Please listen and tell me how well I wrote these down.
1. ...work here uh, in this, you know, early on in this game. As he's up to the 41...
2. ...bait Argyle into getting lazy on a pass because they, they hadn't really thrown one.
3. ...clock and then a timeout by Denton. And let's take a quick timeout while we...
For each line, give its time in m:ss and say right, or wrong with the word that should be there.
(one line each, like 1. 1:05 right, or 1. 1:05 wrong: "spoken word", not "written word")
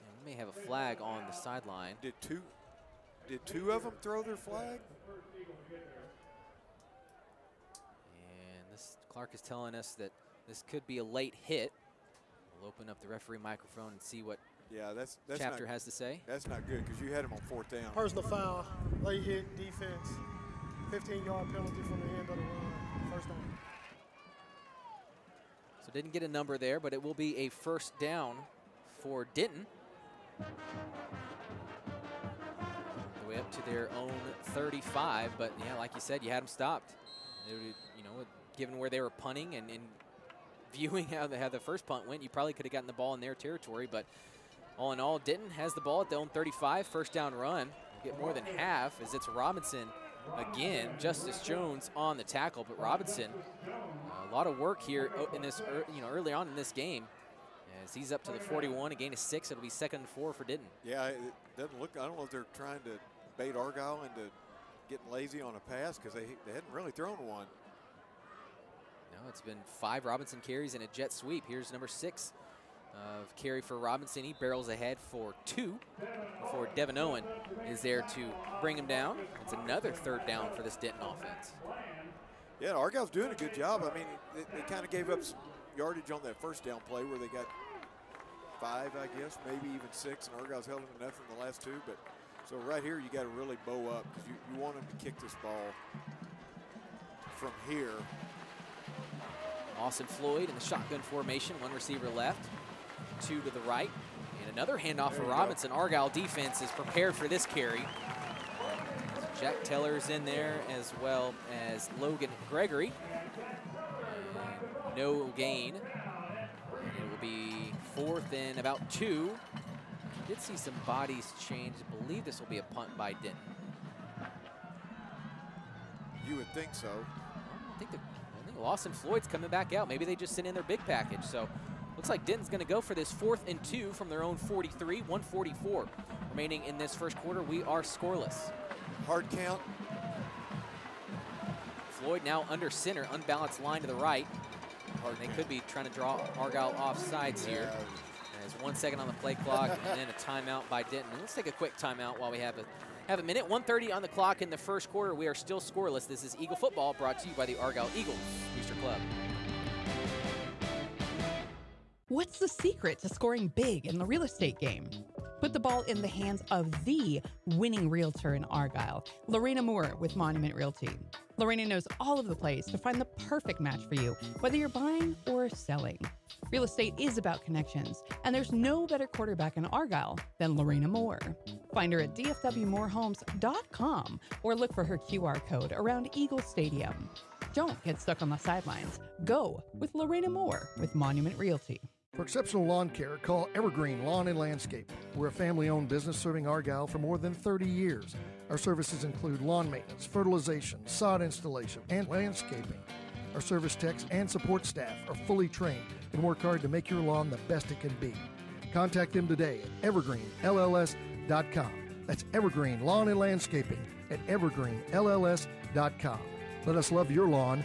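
1. 0:54 right
2. 1:03 right
3. 2:29 right.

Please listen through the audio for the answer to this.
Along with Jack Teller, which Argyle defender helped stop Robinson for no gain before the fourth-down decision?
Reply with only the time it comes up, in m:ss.
1:51.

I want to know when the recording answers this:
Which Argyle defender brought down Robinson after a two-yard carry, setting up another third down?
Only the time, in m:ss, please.
1:16.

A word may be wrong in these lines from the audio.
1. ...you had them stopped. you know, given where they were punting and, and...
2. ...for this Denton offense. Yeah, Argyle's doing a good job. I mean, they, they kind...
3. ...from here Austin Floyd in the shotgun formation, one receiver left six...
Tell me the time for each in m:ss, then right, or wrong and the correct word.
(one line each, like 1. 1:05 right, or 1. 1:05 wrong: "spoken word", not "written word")
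1. 0:36 right
2. 1:20 right
3. 1:37 wrong: "two", not "six".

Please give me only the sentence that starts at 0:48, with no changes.
You get more than half as it's Robinson – again.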